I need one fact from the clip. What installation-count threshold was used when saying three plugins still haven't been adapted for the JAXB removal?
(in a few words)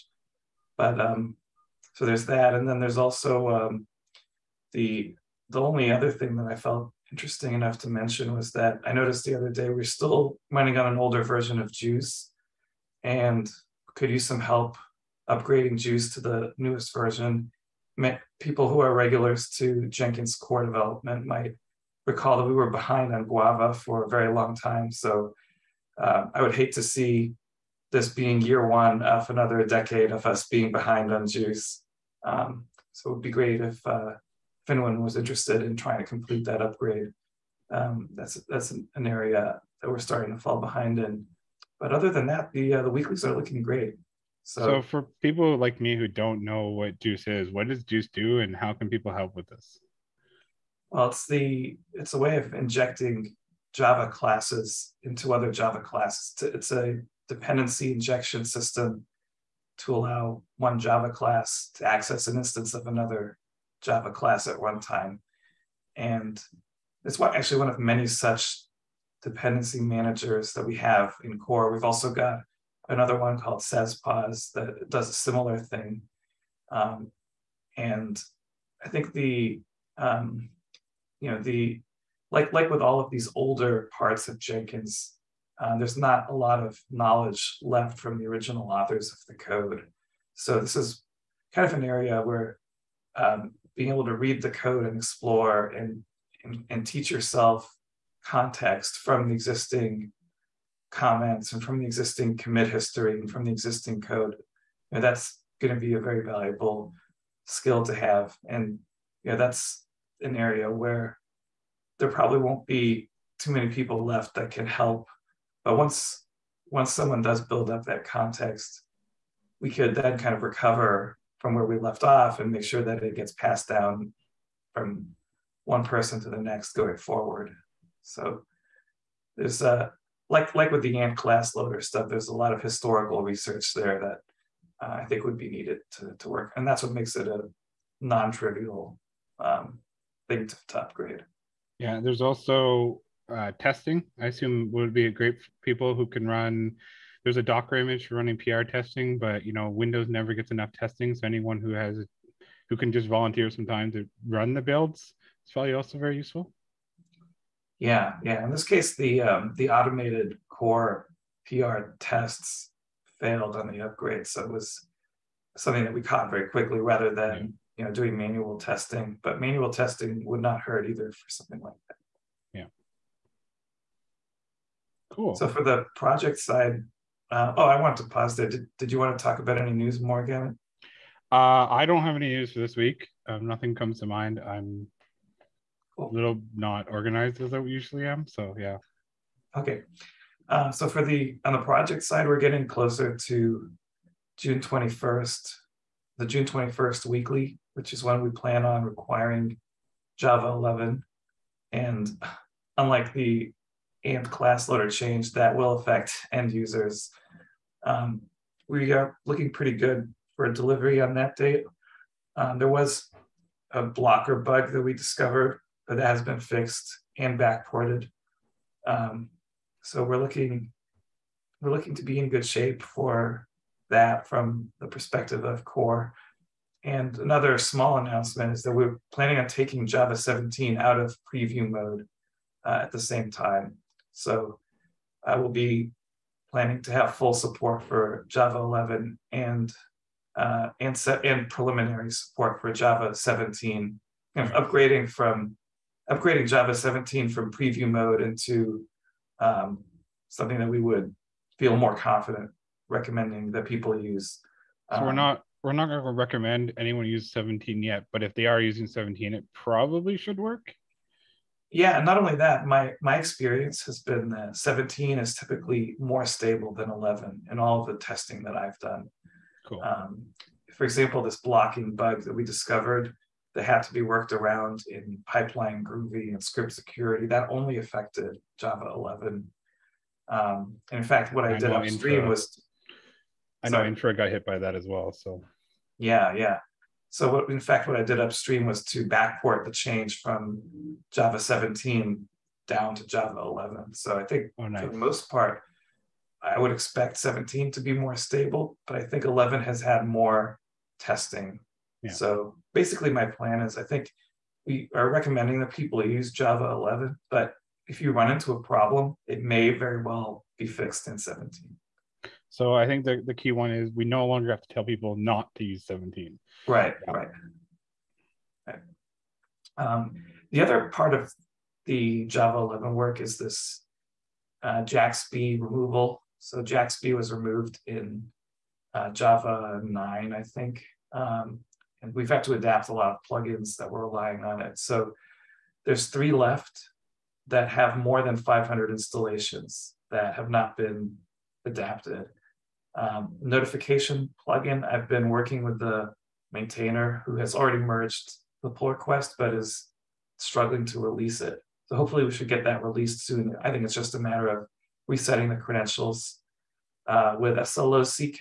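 500.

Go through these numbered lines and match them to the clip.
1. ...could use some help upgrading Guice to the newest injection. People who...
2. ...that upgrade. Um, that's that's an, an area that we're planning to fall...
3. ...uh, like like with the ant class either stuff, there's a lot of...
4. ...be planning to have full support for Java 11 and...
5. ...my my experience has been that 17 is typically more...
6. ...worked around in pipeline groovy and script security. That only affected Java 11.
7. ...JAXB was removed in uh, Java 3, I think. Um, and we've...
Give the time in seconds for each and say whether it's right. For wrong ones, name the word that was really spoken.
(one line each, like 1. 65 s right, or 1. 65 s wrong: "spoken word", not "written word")
1. 13 s wrong: "version", not "injection"
2. 36 s wrong: "starting", not "planning"
3. 129 s wrong: "loader", not "either"
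4. 235 s right
5. 262 s right
6. 274 s right
7. 326 s wrong: "9", not "3".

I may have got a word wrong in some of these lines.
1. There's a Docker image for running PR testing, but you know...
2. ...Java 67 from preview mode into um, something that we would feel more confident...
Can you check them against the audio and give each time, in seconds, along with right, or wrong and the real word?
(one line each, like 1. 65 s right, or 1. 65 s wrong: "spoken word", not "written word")
1. 147 s right
2. 246 s wrong: "17", not "67".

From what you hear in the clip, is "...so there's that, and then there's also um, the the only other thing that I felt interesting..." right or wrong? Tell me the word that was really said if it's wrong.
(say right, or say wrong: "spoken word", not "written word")
right.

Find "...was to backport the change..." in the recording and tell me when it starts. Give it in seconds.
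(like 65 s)
288 s.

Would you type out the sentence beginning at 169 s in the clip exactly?
But manual testing would not hurt either for something like that.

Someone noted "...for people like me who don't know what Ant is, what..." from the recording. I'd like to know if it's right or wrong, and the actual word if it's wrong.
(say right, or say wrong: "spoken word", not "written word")
wrong: "Guice", not "Ant".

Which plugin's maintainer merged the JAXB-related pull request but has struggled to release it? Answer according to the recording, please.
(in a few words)
notification plugin.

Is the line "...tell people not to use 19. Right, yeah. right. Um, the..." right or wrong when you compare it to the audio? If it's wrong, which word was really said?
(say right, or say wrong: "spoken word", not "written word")
wrong: "17", not "19".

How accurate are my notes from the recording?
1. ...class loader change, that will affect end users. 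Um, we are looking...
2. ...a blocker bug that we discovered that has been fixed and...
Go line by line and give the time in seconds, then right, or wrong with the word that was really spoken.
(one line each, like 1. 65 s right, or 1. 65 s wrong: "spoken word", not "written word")
1. 204 s right
2. 213 s right.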